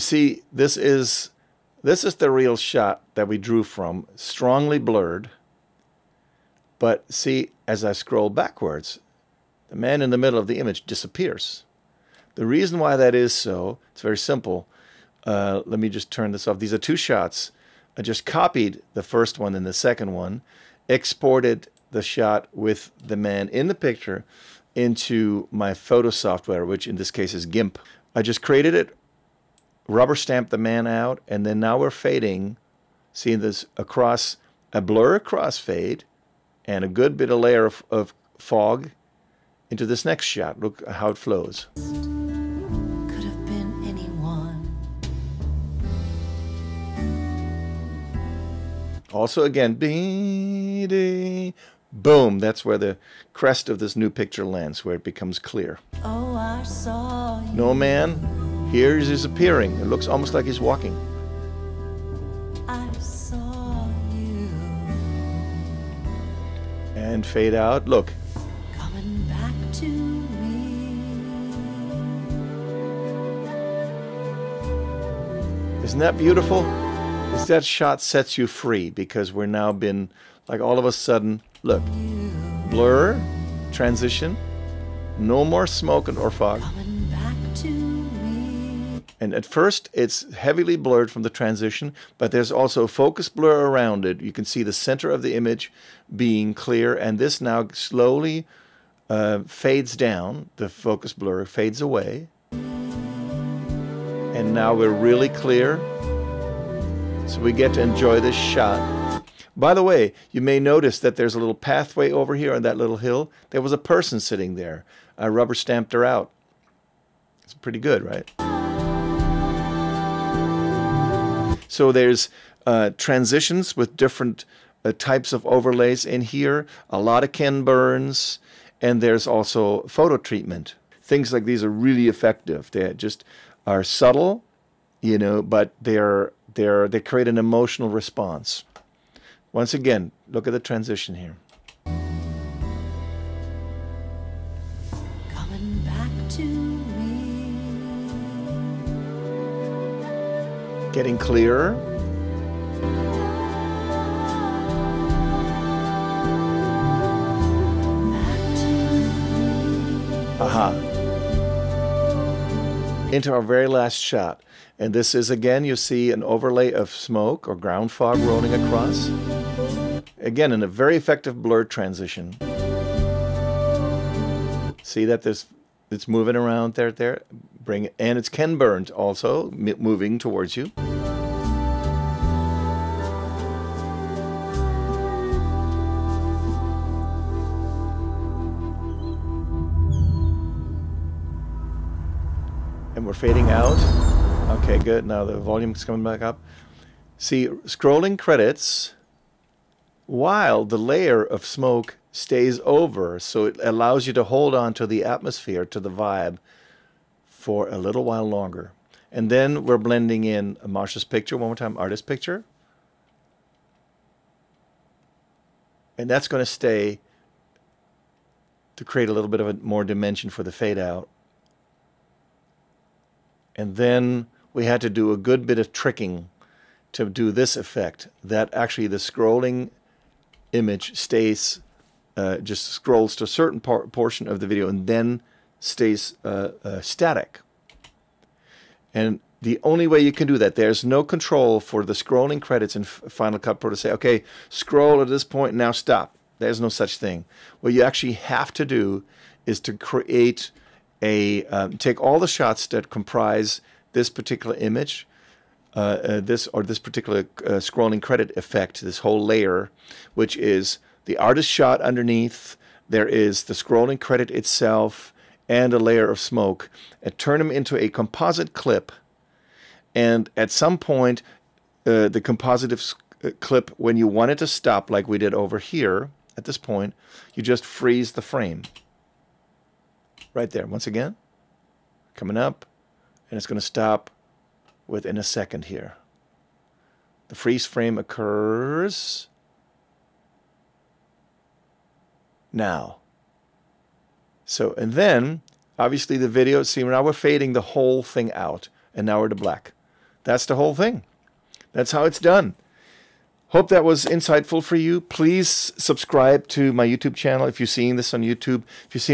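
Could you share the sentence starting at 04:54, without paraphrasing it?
So, and then obviously the video, see, now we're fading the whole thing out and now we're to black.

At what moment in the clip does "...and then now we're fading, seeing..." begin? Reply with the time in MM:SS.
00:31.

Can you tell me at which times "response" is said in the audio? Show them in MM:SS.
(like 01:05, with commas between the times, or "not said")
02:17.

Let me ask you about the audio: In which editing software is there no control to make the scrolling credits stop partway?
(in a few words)
Final Cut Pro.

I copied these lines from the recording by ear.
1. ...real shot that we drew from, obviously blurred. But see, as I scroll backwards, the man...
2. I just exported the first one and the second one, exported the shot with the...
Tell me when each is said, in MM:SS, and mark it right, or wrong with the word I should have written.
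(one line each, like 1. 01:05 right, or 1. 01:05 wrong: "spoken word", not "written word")
1. 00:02 wrong: "strongly", not "obviously"
2. 00:17 wrong: "copied", not "exported".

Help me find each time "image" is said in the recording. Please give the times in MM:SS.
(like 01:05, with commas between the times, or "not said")
00:10, 01:35, 03:50, 04:14.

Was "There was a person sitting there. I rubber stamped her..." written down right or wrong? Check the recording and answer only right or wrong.
right.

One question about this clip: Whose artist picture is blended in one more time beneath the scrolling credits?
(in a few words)
Marsha.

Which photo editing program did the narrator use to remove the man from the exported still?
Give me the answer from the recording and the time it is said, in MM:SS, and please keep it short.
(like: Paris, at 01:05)
GIMP, at 00:27.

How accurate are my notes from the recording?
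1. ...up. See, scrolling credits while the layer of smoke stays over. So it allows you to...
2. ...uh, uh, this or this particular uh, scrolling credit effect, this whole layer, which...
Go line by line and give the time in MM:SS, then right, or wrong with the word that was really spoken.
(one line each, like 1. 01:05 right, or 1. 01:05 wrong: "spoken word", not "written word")
1. 03:16 right
2. 04:15 right.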